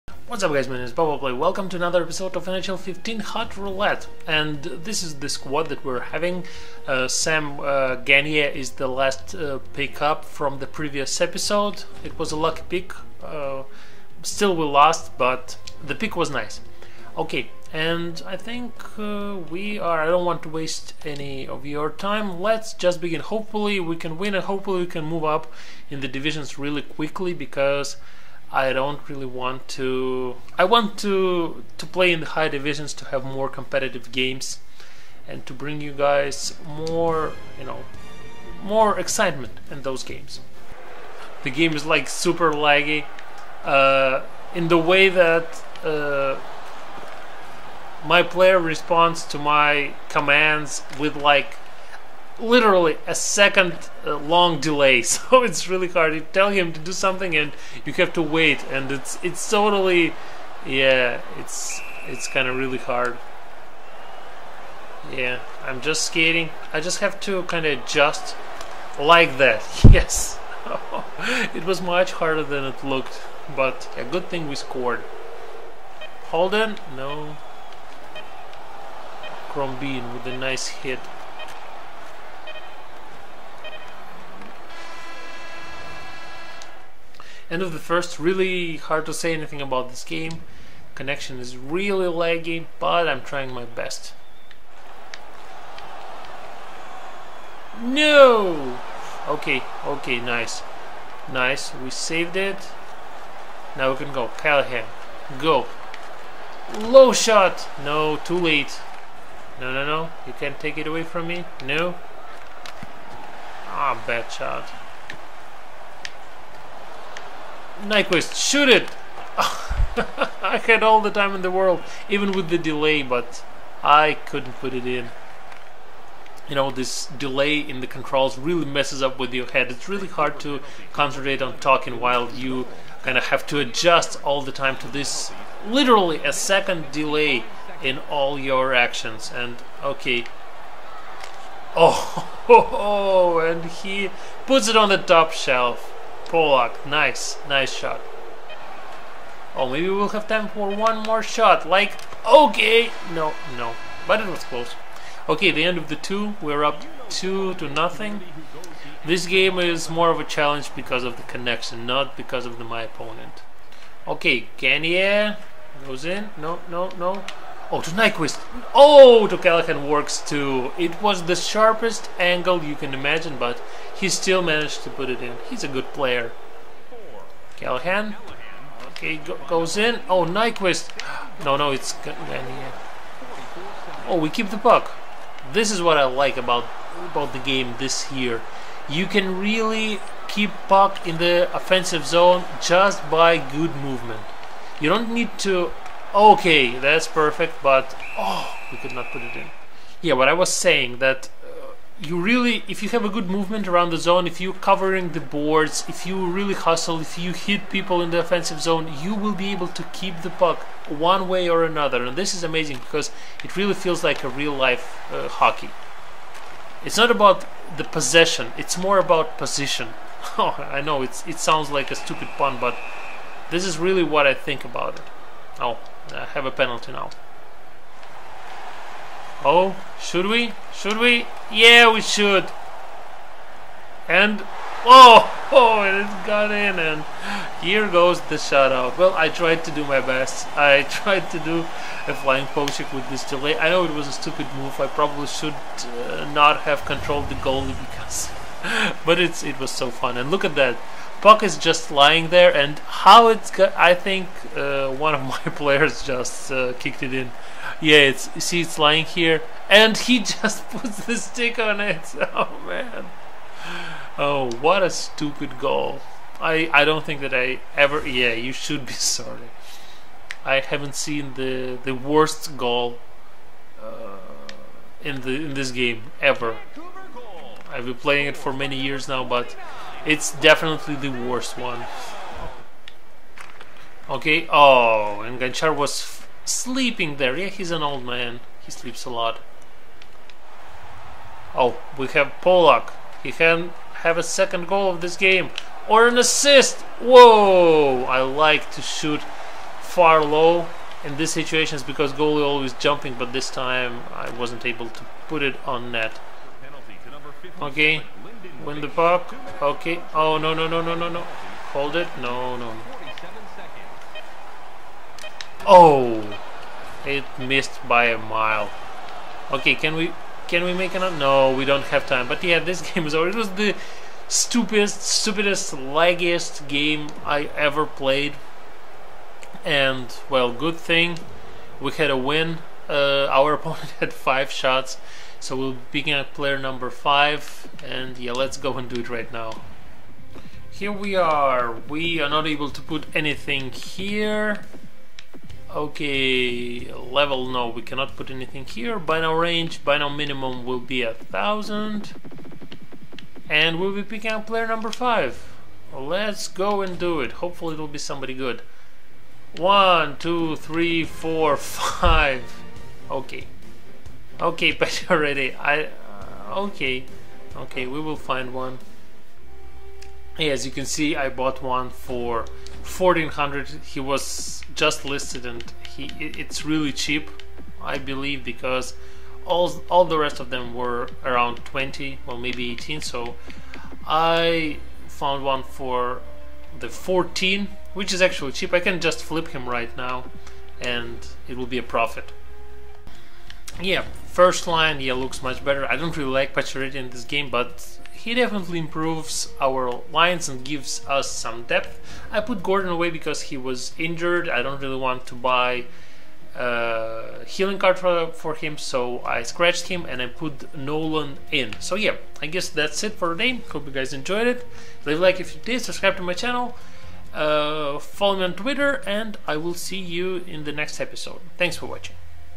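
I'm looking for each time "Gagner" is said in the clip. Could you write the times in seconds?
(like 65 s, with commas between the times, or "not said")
7 s, 164 s, 182 s.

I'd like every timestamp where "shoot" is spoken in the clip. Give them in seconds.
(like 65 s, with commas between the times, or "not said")
118 s, 298 s.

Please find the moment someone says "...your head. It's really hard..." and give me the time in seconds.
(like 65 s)
129 s.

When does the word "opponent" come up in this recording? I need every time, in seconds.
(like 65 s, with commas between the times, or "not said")
162 s, 333 s.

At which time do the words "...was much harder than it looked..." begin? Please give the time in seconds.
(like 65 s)
71 s.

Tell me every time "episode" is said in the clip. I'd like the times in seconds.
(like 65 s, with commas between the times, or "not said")
2 s, 11 s, 421 s.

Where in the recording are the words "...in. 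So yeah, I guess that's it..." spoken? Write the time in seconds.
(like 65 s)
411 s.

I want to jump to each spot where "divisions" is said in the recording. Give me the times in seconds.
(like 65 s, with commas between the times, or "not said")
26 s, 32 s.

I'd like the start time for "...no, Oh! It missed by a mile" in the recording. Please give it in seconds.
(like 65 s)
312 s.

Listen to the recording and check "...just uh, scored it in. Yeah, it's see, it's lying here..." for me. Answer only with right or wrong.
wrong.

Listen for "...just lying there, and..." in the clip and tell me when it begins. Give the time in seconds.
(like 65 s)
251 s.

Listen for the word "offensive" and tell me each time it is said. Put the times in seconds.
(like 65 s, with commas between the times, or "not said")
191 s, 208 s.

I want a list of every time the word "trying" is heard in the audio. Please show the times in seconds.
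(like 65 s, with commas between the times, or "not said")
93 s.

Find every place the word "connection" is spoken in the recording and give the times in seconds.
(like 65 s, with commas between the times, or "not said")
90 s, 161 s.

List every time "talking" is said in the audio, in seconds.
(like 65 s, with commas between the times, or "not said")
131 s.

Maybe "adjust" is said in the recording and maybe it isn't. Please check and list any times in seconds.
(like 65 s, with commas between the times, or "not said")
67 s, 133 s.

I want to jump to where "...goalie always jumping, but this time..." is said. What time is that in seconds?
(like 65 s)
302 s.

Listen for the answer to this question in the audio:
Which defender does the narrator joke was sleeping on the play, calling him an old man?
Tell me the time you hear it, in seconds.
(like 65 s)
285 s.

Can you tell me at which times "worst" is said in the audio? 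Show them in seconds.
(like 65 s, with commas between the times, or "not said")
271 s, 281 s.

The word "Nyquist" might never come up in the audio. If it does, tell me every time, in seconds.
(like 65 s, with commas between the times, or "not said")
117 s, 167 s, 180 s.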